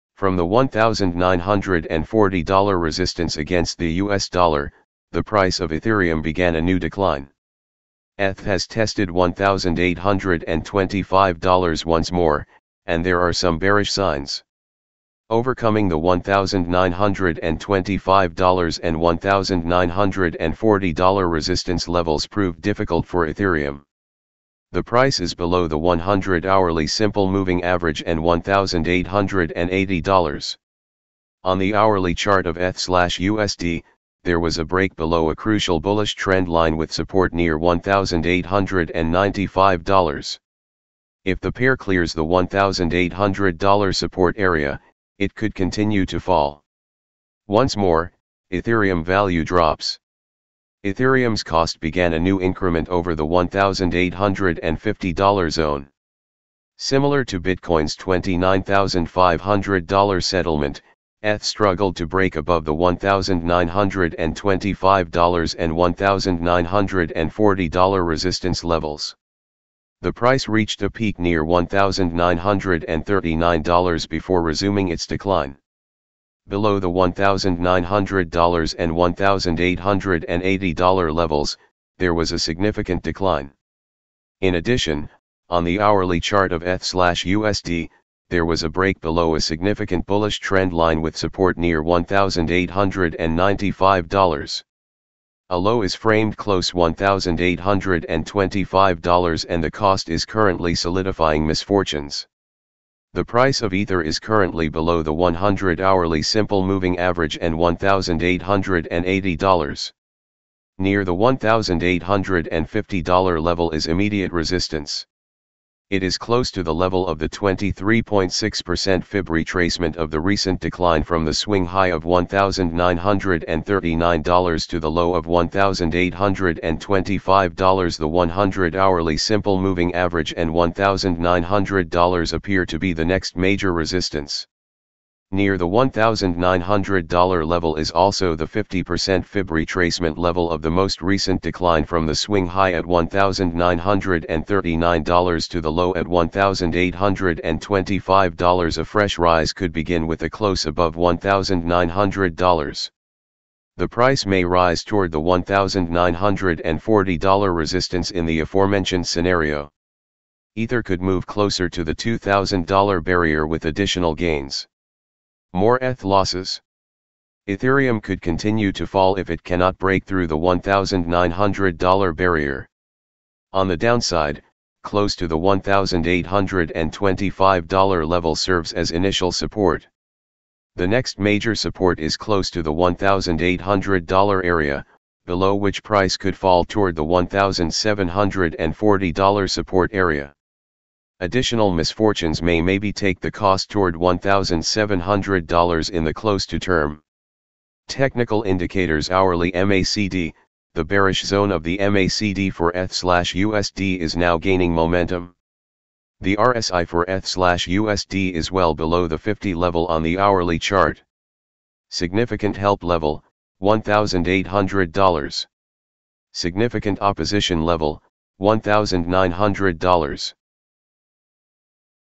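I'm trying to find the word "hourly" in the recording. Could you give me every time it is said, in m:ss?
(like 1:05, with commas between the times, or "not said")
0:26, 0:31, 1:25, 1:45, 2:08, 3:19, 3:30.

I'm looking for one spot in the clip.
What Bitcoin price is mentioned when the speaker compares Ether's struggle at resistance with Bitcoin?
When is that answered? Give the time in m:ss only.
0:57.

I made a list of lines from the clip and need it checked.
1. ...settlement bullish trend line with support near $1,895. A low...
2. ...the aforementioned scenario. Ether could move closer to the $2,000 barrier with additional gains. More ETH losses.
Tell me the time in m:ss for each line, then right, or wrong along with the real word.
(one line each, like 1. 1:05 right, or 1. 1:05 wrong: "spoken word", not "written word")
1. 1:29 wrong: "significant", not "settlement"
2. 2:38 right.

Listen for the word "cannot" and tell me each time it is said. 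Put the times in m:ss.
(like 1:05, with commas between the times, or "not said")
2:49.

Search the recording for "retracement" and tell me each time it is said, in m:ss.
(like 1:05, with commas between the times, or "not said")
1:59, 2:19.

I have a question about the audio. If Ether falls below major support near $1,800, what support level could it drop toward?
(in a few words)
$1,740.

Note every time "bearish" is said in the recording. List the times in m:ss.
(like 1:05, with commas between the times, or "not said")
0:13, 3:20.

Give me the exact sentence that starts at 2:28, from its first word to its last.
A fresh rise could begin with a close above $1,900.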